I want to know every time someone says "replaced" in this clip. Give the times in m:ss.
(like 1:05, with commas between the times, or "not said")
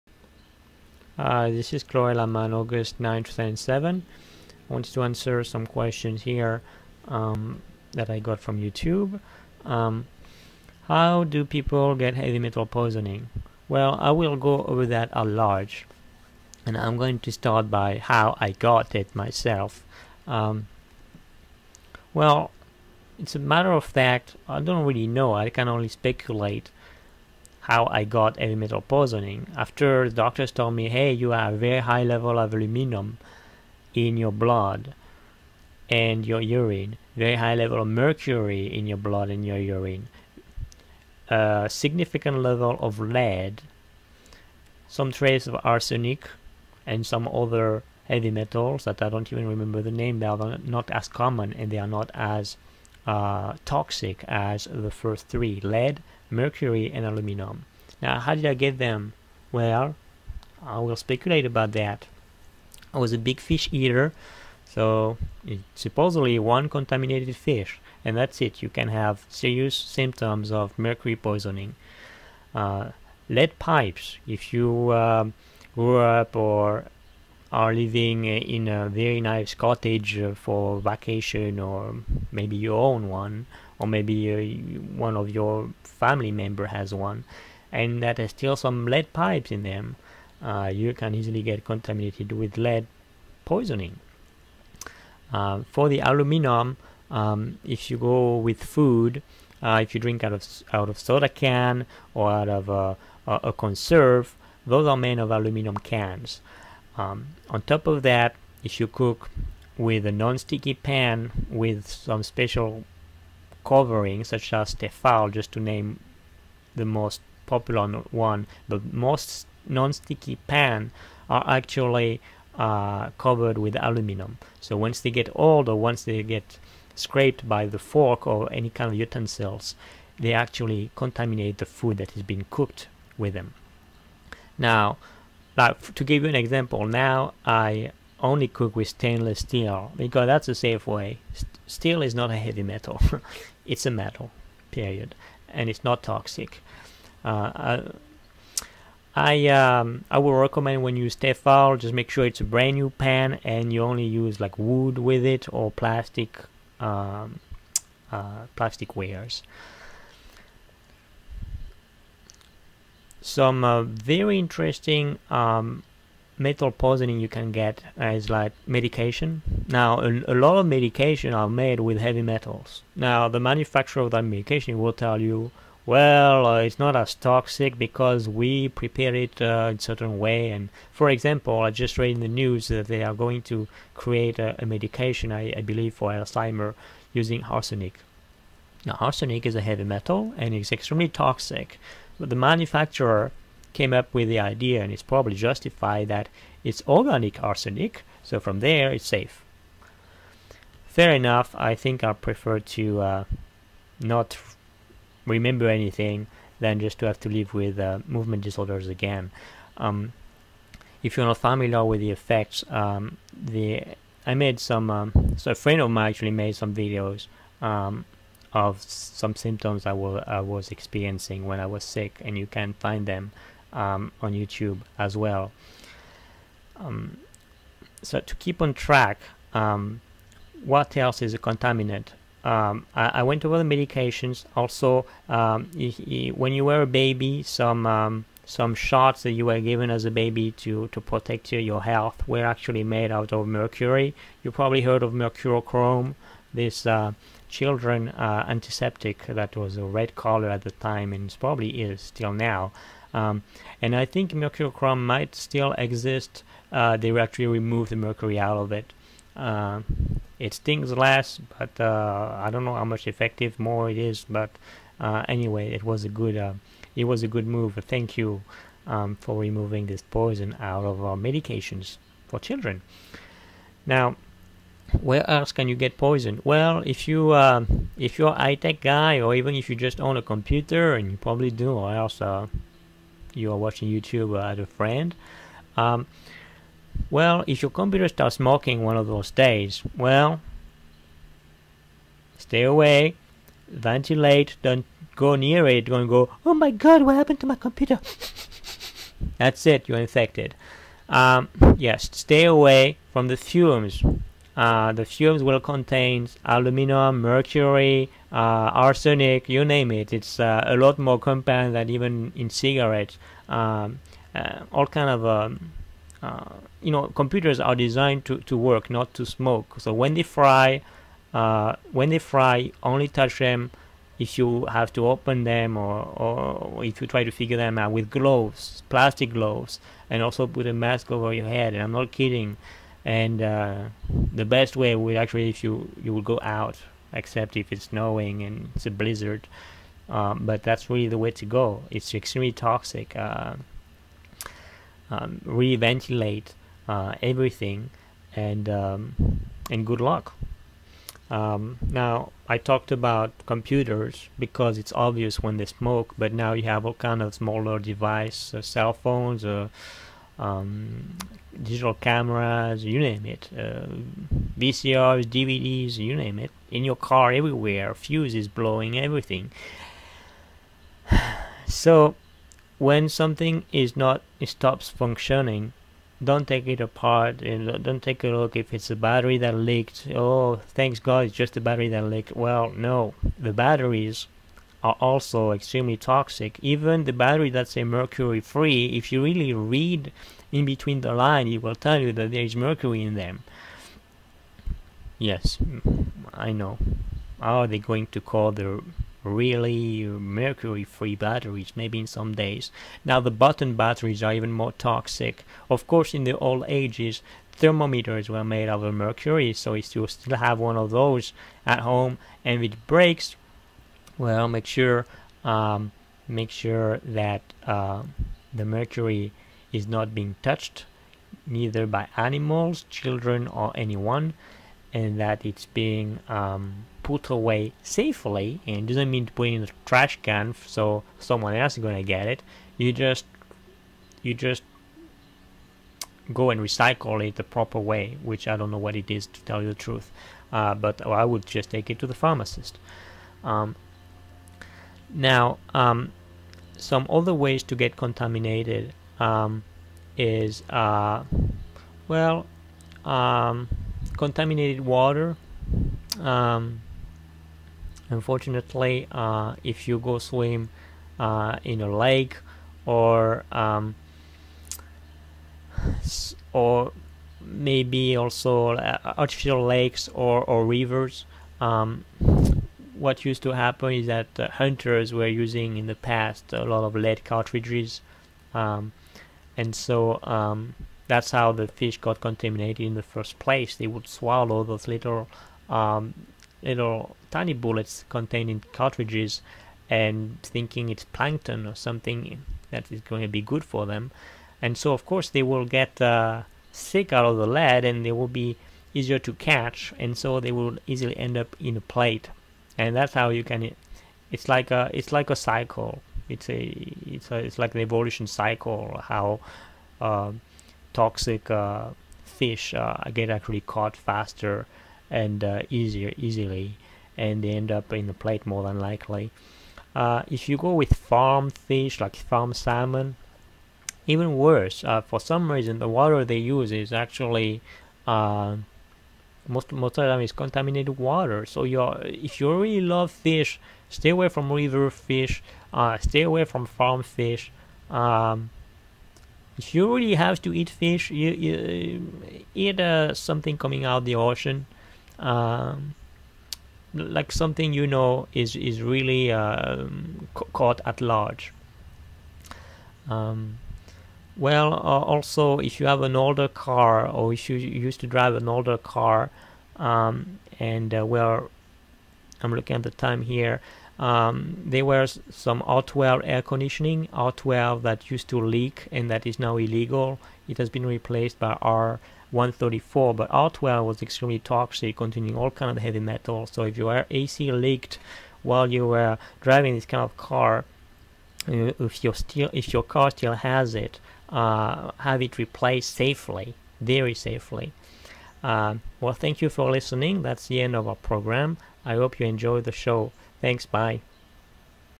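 9:30, 9:45.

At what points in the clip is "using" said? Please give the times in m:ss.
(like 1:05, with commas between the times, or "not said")
3:07, 7:55.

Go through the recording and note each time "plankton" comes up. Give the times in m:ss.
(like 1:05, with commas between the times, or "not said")
8:11.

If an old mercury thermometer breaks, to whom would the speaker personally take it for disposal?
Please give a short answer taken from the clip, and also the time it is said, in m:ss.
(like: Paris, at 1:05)
The pharmacist, at 7:22.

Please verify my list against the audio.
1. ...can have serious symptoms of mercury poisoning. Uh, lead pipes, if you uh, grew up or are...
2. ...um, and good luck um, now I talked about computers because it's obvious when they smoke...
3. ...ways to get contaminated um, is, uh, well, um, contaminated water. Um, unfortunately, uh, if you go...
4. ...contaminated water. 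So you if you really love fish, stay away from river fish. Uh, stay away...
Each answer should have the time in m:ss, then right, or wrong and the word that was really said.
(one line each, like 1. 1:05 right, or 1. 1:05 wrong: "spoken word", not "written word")
1. 1:08 right
2. 5:48 right
3. 7:27 right
4. 8:50 right.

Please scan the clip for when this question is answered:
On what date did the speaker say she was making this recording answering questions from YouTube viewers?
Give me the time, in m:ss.
0:02.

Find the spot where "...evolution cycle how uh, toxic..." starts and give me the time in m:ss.
8:27.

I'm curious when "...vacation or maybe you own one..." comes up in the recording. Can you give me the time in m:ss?
1:20.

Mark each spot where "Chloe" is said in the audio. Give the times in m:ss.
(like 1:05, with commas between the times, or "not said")
0:01.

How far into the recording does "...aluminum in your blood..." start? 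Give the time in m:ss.
0:32.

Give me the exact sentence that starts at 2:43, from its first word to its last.
some uh, very interesting um, metal poisoning you can get is like medication.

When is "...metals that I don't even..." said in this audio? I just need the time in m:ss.
0:48.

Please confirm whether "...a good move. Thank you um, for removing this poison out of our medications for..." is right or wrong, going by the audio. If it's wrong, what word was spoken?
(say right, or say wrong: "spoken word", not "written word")
right.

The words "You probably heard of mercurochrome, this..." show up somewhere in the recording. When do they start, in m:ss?
4:04.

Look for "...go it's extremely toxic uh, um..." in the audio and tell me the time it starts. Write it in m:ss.
5:41.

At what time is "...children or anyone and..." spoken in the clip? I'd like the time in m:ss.
7:02.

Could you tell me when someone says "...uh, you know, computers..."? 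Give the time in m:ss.
5:16.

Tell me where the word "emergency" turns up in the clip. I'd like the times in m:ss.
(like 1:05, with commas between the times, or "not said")
not said.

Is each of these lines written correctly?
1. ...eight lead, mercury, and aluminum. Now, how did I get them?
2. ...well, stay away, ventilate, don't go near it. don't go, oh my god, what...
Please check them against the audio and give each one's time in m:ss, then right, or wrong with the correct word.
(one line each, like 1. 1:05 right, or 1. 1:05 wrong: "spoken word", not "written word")
1. 0:55 wrong: "three", not "eight"
2. 4:49 right.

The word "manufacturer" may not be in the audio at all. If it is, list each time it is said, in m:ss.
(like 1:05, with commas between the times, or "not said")
2:53, 3:12.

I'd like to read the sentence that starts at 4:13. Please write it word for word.
Um, and I think chrome might still exist.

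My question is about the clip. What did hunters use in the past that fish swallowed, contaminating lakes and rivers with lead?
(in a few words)
Lead cartridges.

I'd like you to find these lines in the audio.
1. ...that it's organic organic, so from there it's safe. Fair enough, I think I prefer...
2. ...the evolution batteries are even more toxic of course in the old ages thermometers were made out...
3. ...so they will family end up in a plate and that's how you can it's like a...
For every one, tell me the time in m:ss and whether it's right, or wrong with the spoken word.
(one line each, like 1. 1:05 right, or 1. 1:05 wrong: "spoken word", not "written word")
1. 3:16 wrong: "arsenic", not "organic"
2. 6:43 wrong: "button", not "evolution"
3. 8:20 wrong: "easily", not "family".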